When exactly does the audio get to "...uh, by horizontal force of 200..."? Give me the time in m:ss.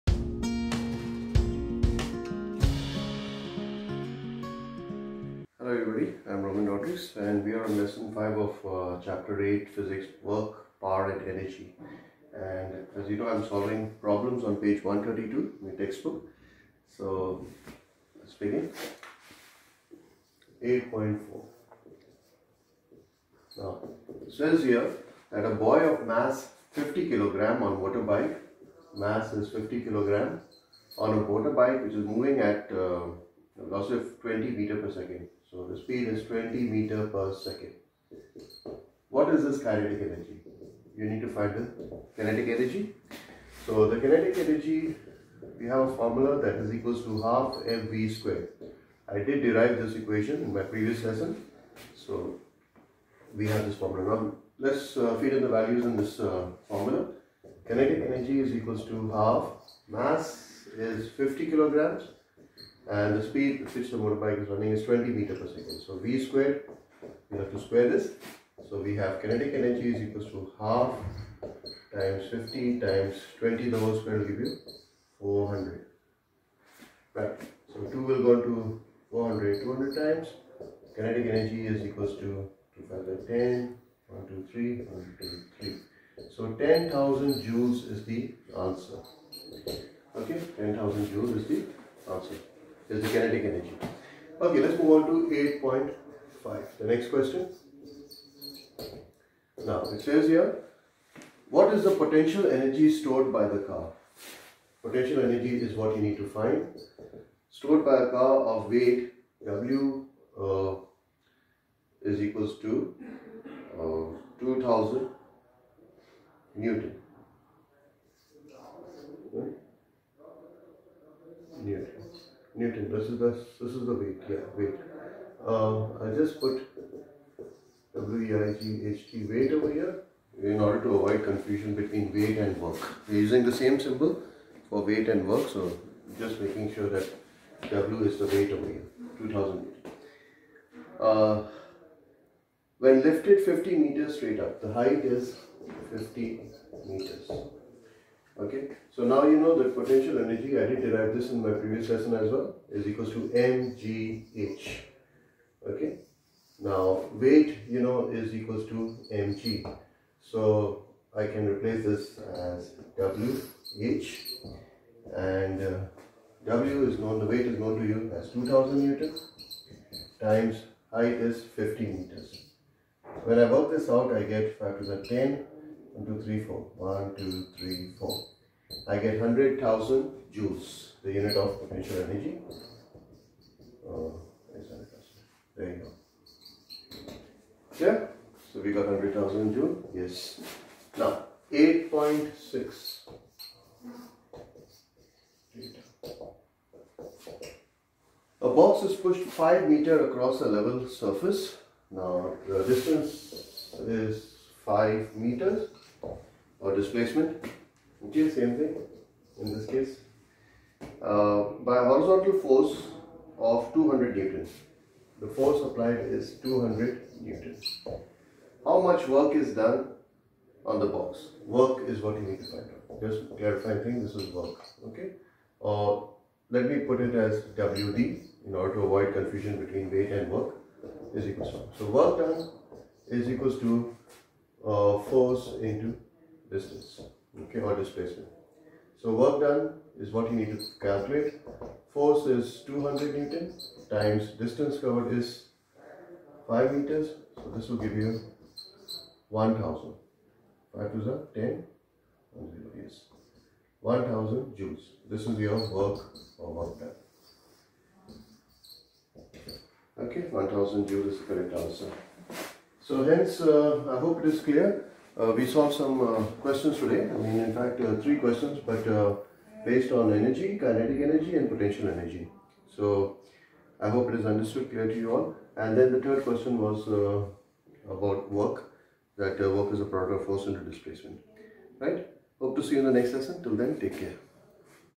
3:31.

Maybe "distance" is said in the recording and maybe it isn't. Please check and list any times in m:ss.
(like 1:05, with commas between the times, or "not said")
3:22, 3:56, 4:04.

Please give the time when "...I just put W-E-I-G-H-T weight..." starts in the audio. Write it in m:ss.
2:06.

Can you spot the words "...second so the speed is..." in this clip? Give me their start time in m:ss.
0:34.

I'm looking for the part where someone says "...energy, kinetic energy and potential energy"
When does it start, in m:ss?
4:30.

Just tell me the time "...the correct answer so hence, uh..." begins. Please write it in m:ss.
4:21.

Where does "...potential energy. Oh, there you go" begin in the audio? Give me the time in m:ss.
3:01.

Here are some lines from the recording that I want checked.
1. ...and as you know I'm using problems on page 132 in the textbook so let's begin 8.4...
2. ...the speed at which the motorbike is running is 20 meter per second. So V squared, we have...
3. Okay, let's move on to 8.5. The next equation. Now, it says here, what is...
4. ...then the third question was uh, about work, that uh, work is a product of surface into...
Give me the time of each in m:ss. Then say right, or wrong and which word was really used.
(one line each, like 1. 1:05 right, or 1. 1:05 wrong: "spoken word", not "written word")
1. 0:12 wrong: "solving", not "using"
2. 1:03 right
3. 1:34 wrong: "question", not "equation"
4. 4:35 wrong: "force", not "surface".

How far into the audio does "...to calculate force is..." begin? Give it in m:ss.
4:00.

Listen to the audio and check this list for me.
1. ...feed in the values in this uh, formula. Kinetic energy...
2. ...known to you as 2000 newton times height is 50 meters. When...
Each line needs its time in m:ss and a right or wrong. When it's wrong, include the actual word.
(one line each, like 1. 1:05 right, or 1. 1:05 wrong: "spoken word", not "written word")
1. 0:55 right
2. 2:47 right.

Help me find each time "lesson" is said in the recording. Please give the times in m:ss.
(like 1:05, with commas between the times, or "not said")
0:07, 0:51, 2:31, 4:43.